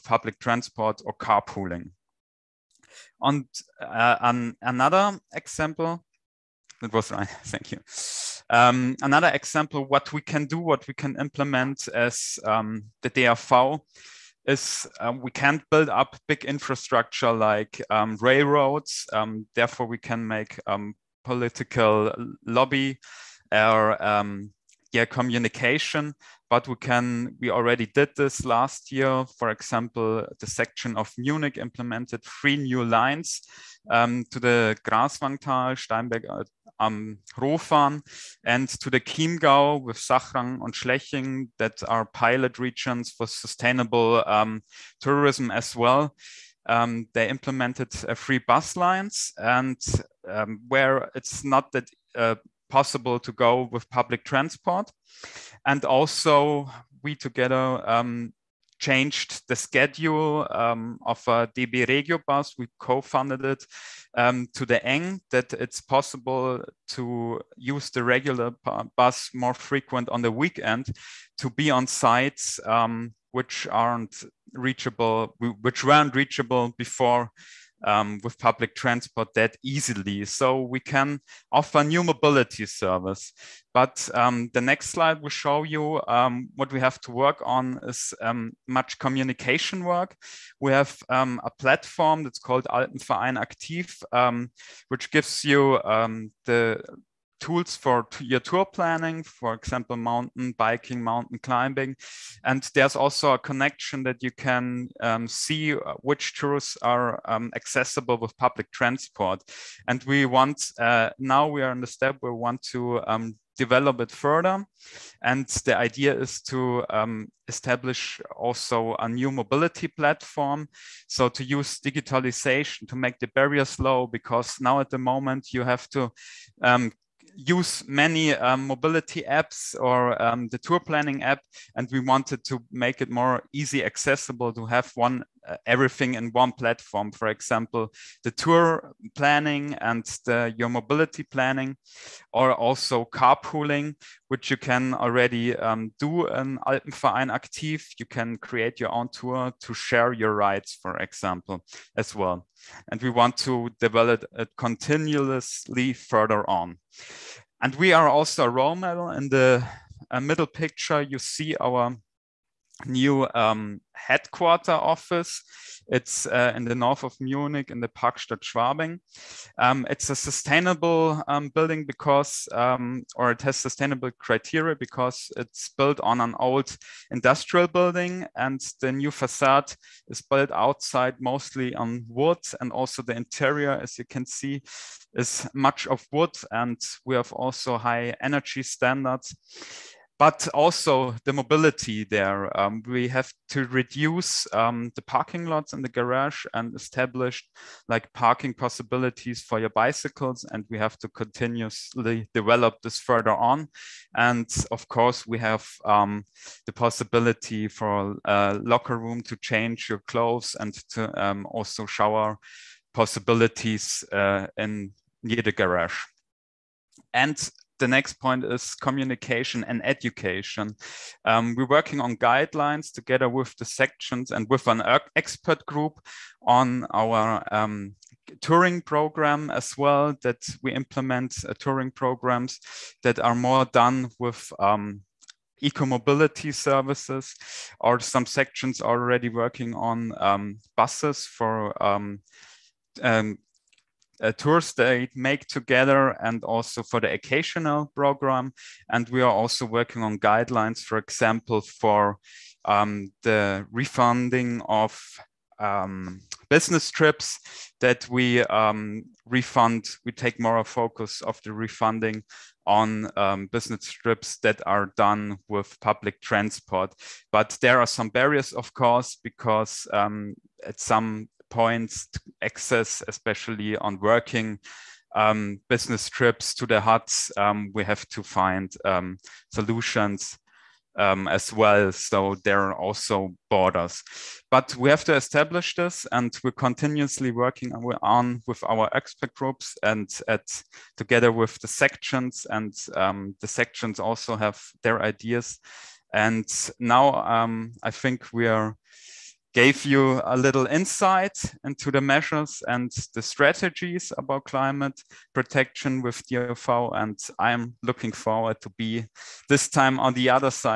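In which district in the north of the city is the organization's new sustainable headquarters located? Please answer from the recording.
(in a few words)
Parkstadt Schwabing.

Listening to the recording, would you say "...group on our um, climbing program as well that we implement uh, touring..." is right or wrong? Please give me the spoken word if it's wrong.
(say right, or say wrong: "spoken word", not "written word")
wrong: "touring", not "climbing".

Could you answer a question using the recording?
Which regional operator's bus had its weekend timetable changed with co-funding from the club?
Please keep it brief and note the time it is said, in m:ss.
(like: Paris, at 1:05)
DB Regio, at 1:01.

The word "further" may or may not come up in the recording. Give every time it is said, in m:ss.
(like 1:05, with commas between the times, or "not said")
1:54, 2:35, 3:22.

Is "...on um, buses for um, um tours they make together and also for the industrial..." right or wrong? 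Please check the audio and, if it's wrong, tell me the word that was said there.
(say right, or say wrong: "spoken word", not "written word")
wrong: "occasional", not "industrial".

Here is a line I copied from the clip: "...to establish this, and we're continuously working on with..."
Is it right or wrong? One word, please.
right.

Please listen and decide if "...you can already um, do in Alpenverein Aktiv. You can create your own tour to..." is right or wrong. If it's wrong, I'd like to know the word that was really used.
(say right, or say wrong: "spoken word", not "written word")
right.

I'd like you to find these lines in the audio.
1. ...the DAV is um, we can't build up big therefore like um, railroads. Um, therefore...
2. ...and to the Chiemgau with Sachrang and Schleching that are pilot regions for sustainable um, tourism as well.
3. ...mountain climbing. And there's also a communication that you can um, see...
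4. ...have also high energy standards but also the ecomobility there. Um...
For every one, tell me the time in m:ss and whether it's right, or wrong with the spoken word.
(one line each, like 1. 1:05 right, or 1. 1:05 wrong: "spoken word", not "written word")
1. 0:13 wrong: "infrastructure", not "therefore"
2. 0:38 right
3. 1:41 wrong: "connection", not "communication"
4. 3:07 wrong: "mobility", not "ecomobility".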